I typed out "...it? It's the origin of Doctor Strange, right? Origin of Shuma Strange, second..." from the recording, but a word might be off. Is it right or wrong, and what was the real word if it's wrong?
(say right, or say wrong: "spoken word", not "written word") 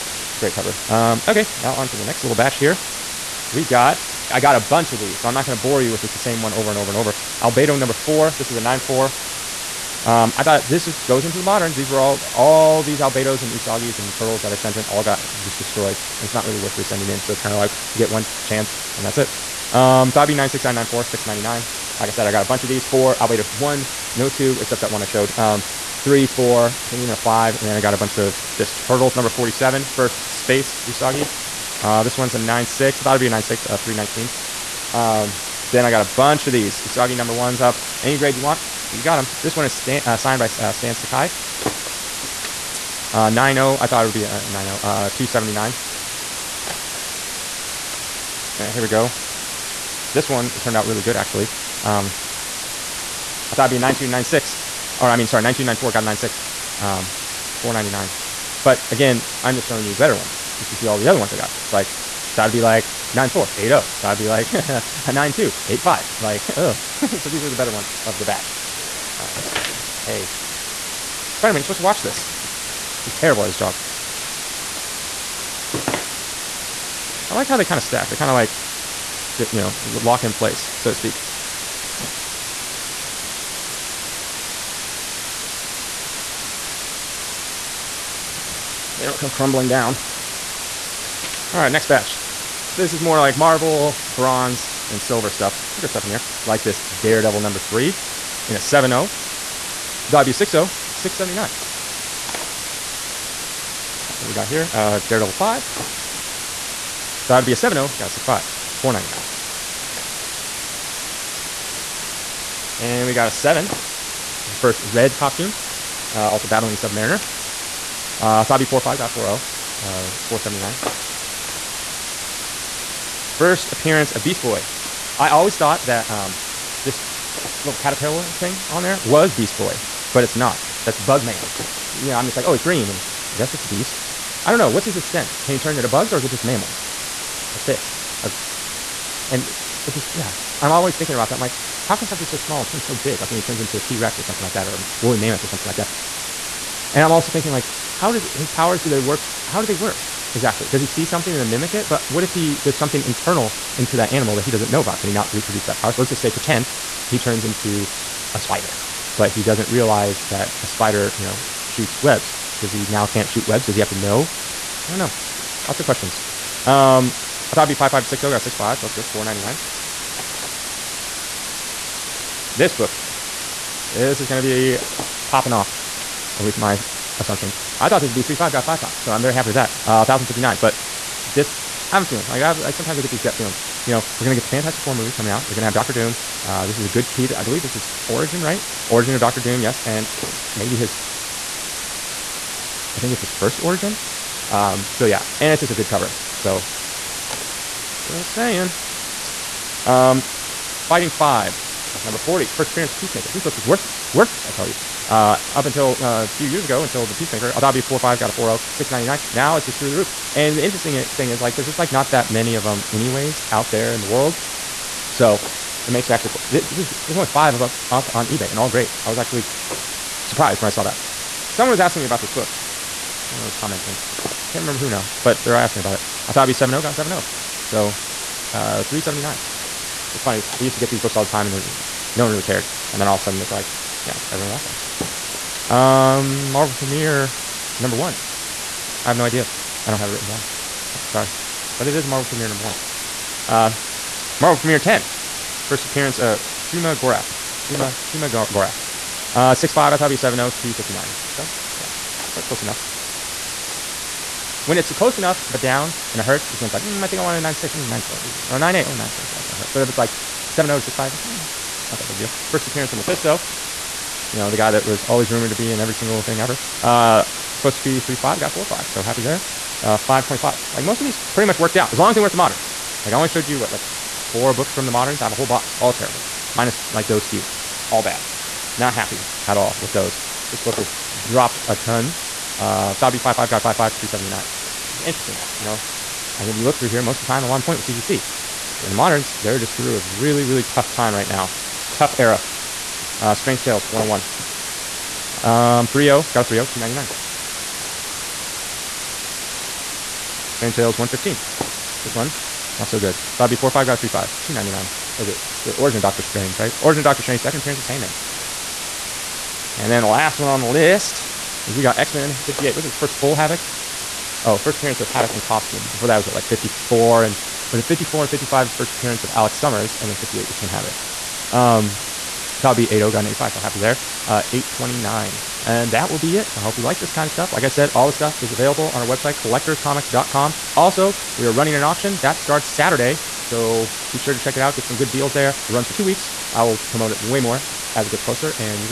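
wrong: "Doctor", not "Shuma".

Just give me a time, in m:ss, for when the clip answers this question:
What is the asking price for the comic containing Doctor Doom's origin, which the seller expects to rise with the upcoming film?
3:00.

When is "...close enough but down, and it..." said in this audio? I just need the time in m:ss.
4:14.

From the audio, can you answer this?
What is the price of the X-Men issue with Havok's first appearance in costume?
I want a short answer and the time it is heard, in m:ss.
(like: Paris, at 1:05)
829, at 5:24.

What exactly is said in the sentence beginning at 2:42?
Does he now can't shoot webs?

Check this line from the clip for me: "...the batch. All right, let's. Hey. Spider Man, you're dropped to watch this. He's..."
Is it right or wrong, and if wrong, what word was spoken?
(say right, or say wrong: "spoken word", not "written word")
wrong: "supposed", not "dropped".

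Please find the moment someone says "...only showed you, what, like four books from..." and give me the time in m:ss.
4:33.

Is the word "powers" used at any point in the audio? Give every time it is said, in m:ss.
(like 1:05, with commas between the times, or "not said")
2:28, 2:35.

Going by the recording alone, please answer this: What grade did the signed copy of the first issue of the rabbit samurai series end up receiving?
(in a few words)
90.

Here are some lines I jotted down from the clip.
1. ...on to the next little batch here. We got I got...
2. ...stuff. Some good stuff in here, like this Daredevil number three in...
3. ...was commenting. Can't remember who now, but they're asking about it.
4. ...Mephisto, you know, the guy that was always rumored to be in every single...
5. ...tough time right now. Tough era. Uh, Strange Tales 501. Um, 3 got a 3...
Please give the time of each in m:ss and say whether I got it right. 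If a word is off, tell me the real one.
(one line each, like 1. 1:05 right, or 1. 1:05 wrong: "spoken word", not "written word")
1. 0:01 right
2. 1:35 right
3. 3:43 right
4. 4:22 right
5. 4:50 wrong: "101", not "501".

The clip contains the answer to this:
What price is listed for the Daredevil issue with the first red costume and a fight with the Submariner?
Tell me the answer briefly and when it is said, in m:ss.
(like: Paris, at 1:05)
479, at 2:00.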